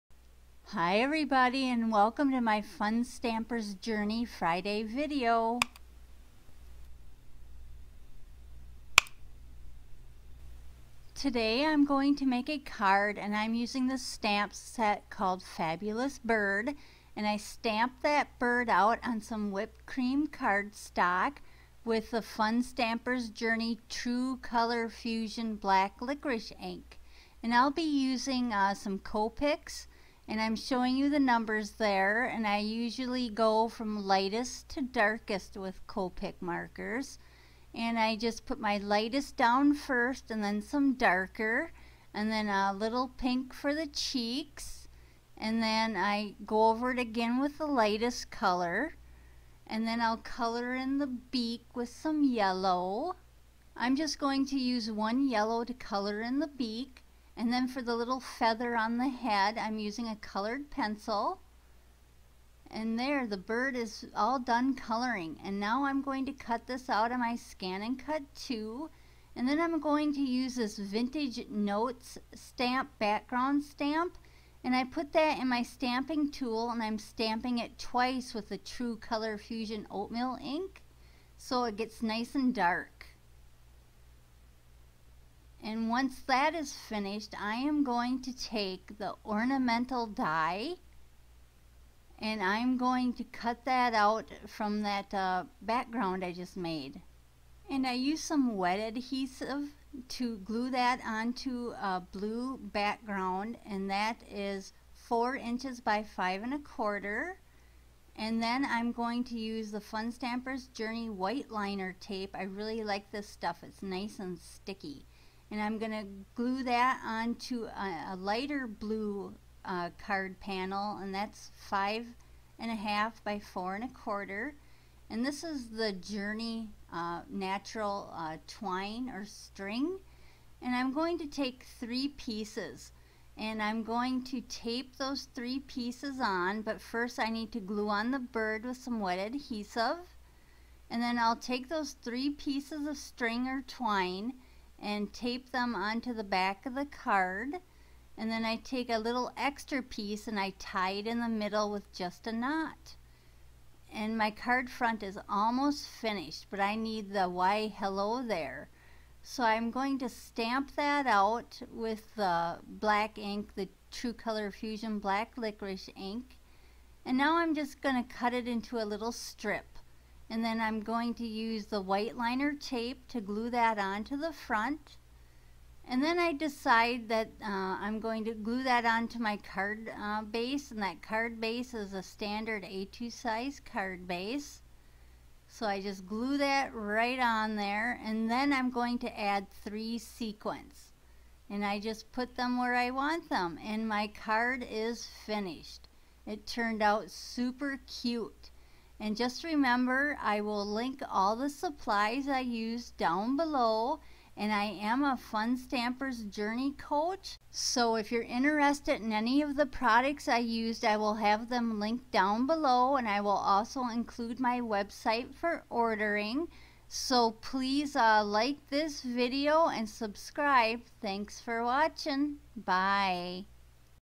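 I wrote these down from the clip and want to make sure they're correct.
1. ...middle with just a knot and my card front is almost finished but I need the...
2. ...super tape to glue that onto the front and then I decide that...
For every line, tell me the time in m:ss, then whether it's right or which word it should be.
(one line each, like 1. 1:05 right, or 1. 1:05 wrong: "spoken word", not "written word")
1. 2:31 right
2. 2:52 wrong: "liner", not "super".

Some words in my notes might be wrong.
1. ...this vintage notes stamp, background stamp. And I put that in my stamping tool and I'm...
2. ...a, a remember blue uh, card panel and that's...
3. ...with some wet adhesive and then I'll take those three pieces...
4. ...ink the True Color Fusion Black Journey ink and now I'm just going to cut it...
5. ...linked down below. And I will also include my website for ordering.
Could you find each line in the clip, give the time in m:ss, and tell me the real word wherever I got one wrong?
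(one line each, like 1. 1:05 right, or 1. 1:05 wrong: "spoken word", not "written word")
1. 1:10 right
2. 1:57 wrong: "lighter", not "remember"
3. 2:18 right
4. 2:43 wrong: "Licorice", not "Journey"
5. 3:31 right.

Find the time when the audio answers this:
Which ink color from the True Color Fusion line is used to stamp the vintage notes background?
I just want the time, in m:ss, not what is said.
1:19.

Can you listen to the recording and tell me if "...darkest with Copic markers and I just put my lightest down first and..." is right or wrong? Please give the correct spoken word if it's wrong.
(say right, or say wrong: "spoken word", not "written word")
right.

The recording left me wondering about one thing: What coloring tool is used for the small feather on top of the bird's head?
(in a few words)
Colored pencil.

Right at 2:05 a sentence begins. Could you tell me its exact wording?
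And this is the Journey uh, natural uh, twine or string.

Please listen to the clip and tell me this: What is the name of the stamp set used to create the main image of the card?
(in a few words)
Fabulous Bird.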